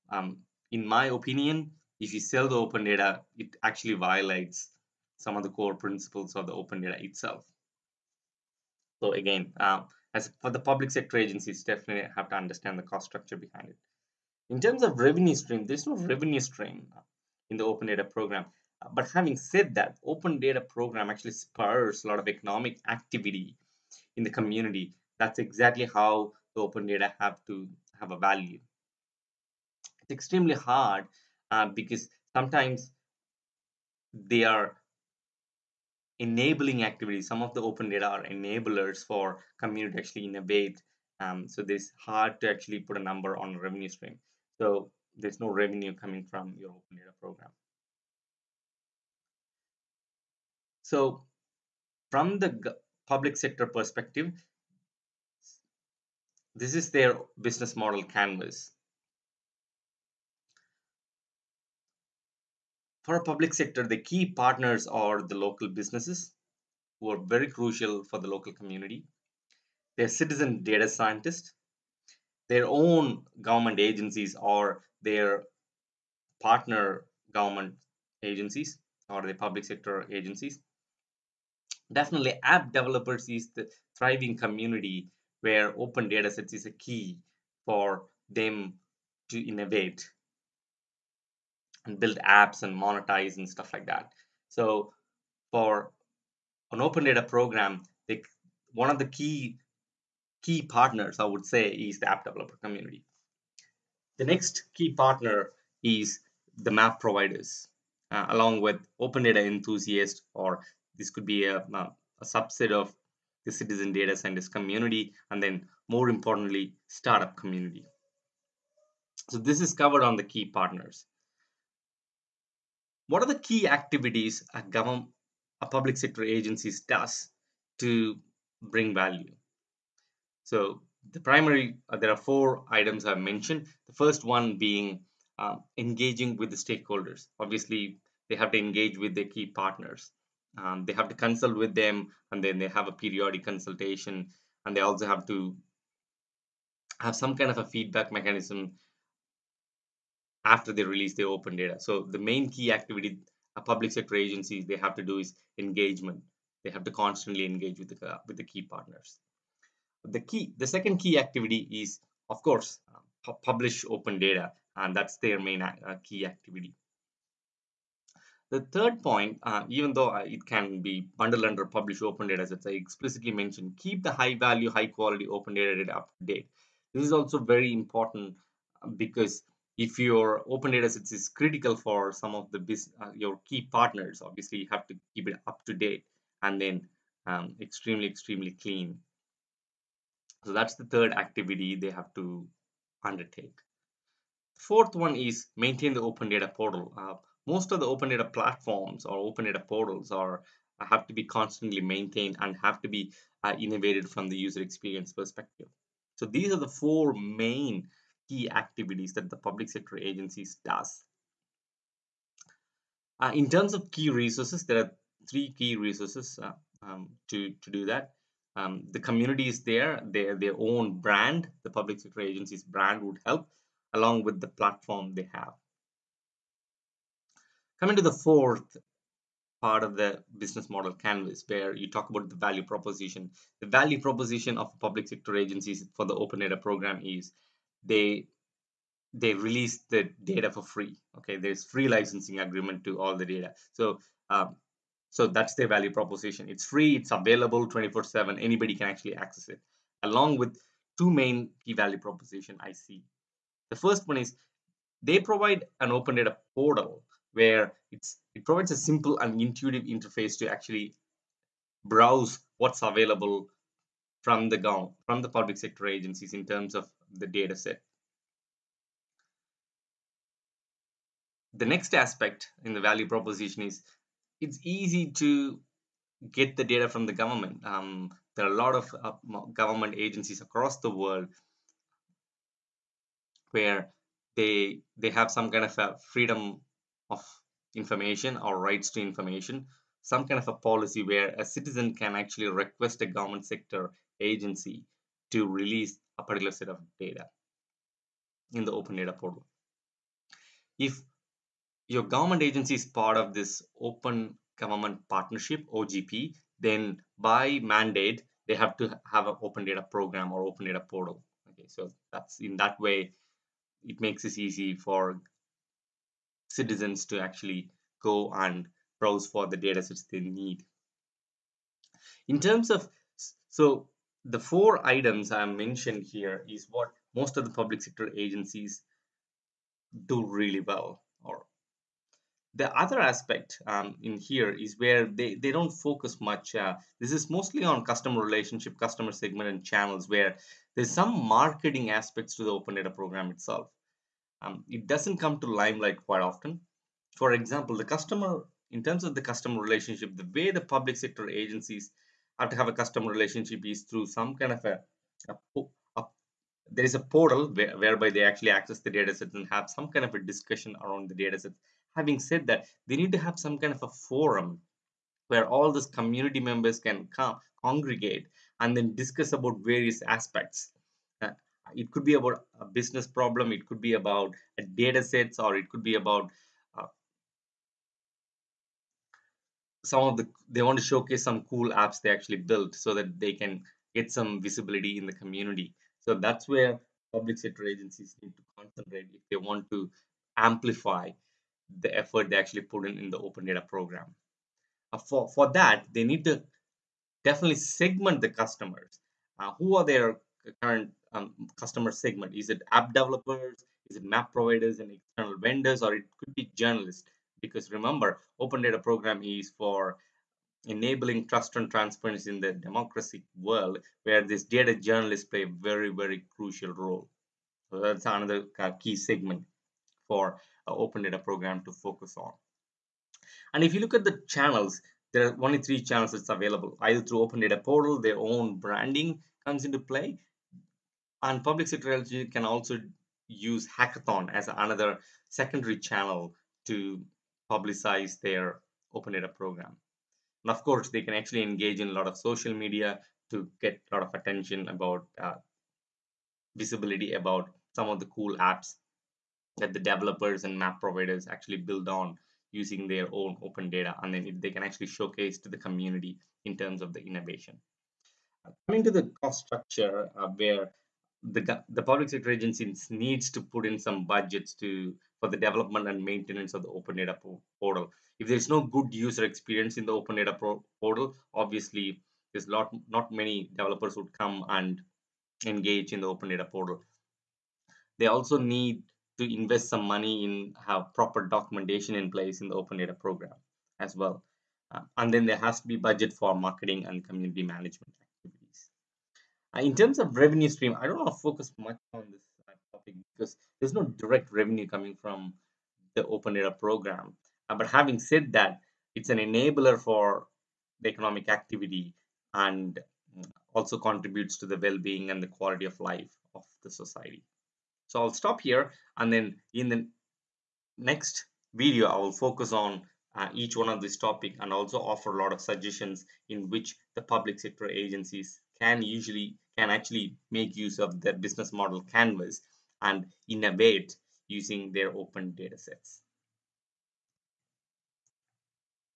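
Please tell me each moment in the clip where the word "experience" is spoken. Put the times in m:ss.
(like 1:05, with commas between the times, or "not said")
3:24, 7:49.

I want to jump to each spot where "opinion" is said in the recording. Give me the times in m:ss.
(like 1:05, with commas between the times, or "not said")
0:01.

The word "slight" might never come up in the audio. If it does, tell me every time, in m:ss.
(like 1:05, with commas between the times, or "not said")
not said.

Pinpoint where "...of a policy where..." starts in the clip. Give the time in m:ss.
4:50.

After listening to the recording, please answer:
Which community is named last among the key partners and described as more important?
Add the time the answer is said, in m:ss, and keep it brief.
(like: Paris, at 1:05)
Startup community, at 1:56.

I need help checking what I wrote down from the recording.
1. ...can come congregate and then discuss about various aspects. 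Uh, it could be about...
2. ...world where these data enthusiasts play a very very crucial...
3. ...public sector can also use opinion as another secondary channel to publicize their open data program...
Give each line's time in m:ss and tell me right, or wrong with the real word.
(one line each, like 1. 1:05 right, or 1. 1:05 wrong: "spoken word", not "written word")
1. 6:06 right
2. 6:53 wrong: "journalists", not "enthusiasts"
3. 7:11 wrong: "hackathon", not "opinion".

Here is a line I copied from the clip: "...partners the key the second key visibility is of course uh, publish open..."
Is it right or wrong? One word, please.
wrong.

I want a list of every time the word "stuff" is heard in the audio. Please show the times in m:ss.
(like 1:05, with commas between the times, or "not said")
1:33.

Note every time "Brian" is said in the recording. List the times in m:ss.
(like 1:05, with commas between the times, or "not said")
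not said.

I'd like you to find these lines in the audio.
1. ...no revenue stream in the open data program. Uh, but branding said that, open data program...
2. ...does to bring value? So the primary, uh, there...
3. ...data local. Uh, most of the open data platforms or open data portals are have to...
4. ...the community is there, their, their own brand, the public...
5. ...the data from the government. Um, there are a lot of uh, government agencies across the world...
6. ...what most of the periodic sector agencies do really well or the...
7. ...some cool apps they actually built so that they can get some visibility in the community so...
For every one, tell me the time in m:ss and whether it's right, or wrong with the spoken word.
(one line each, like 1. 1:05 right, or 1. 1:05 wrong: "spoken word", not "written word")
1. 0:15 wrong: "having", not "branding"
2. 2:06 right
3. 3:16 wrong: "portal", not "local"
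4. 3:38 right
5. 4:36 right
6. 5:26 wrong: "public", not "periodic"
7. 6:21 right.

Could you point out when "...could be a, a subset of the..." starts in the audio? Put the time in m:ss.
1:51.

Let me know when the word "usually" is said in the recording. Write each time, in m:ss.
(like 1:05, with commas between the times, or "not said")
8:38.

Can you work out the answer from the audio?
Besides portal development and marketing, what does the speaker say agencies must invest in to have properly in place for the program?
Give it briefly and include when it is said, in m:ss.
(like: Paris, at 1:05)
Documentation, at 8:01.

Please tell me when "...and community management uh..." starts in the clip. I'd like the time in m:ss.
8:06.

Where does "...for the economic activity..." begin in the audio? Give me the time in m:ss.
8:19.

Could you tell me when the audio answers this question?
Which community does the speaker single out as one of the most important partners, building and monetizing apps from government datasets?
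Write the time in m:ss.
1:42.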